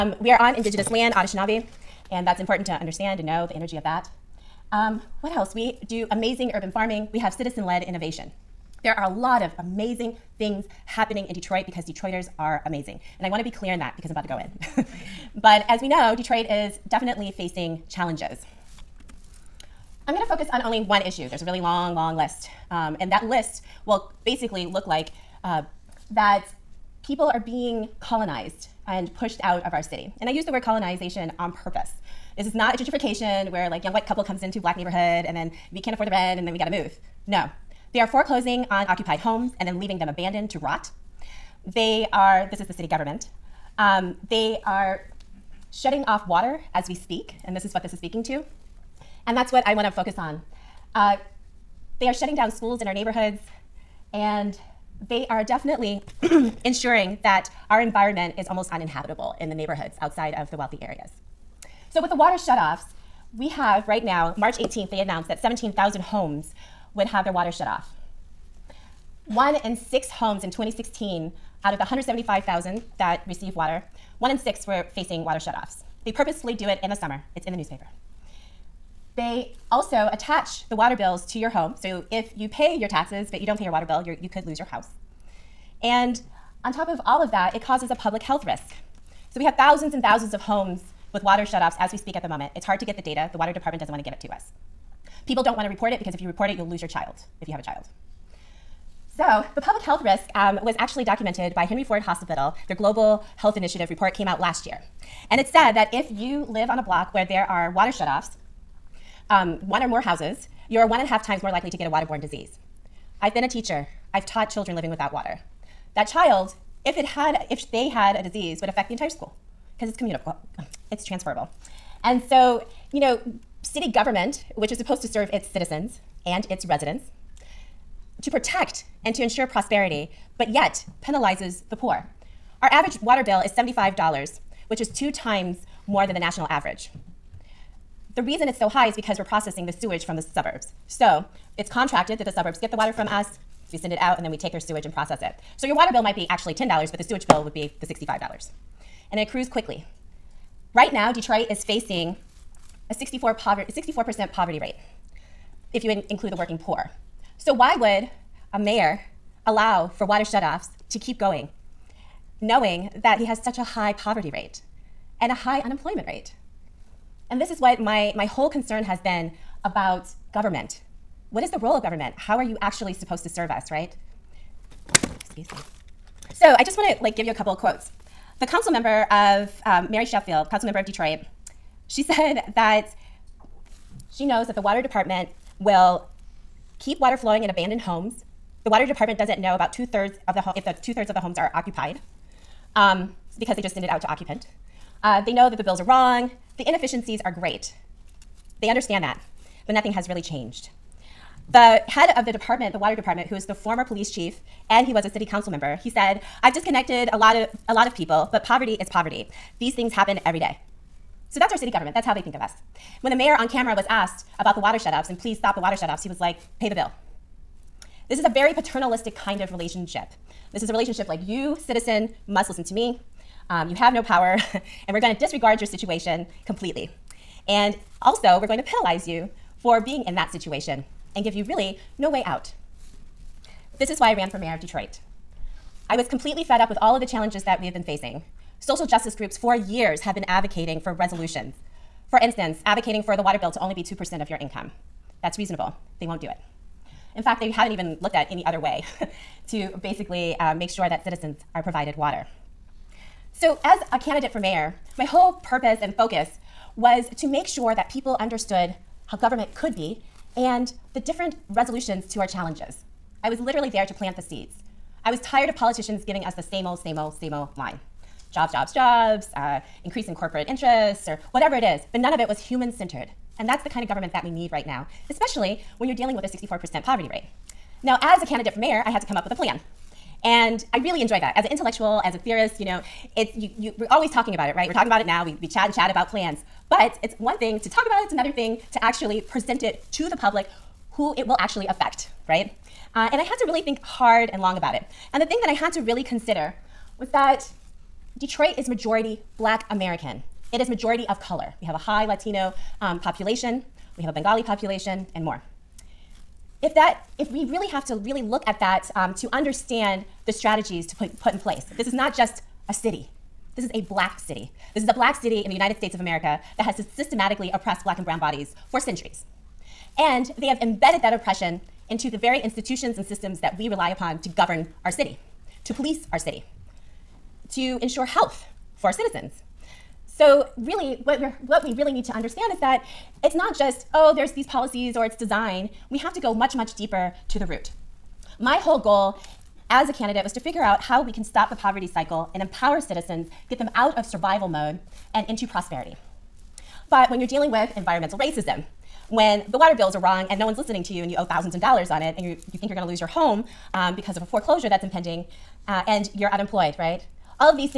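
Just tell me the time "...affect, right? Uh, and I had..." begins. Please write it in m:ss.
4:51.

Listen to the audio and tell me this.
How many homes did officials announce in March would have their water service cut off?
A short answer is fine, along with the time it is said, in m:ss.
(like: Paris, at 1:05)
17,000, at 1:05.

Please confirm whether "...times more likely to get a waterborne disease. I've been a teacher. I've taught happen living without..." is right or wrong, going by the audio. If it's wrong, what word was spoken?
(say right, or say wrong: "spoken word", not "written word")
wrong: "children", not "happen".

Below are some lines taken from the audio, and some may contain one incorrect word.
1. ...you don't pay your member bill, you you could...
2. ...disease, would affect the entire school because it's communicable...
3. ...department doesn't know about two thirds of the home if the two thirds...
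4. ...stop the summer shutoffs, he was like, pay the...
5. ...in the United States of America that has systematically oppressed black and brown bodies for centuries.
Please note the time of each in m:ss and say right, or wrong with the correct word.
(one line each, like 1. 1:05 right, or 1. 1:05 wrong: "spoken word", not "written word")
1. 1:23 wrong: "water", not "member"
2. 1:58 right
3. 3:08 right
4. 3:35 wrong: "water", not "summer"
5. 5:15 right.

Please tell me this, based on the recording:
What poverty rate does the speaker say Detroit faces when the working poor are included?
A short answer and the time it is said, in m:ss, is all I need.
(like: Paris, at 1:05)
64%, at 2:32.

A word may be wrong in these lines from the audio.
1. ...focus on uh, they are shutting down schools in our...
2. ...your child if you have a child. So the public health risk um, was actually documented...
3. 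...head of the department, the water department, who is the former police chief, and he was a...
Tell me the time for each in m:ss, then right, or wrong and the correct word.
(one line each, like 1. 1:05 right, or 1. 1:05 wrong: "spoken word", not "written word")
1. 0:49 right
2. 1:36 right
3. 3:21 right.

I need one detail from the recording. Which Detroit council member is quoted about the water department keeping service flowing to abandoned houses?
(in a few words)
Mary Sheffield.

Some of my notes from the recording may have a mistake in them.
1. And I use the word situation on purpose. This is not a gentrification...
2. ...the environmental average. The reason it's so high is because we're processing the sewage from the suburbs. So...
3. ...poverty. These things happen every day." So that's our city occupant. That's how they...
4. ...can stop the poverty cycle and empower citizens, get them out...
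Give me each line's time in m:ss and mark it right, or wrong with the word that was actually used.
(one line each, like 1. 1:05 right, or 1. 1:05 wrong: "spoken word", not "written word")
1. 0:30 wrong: "colonization", not "situation"
2. 2:16 wrong: "national", not "environmental"
3. 3:28 wrong: "government", not "occupant"
4. 5:41 right.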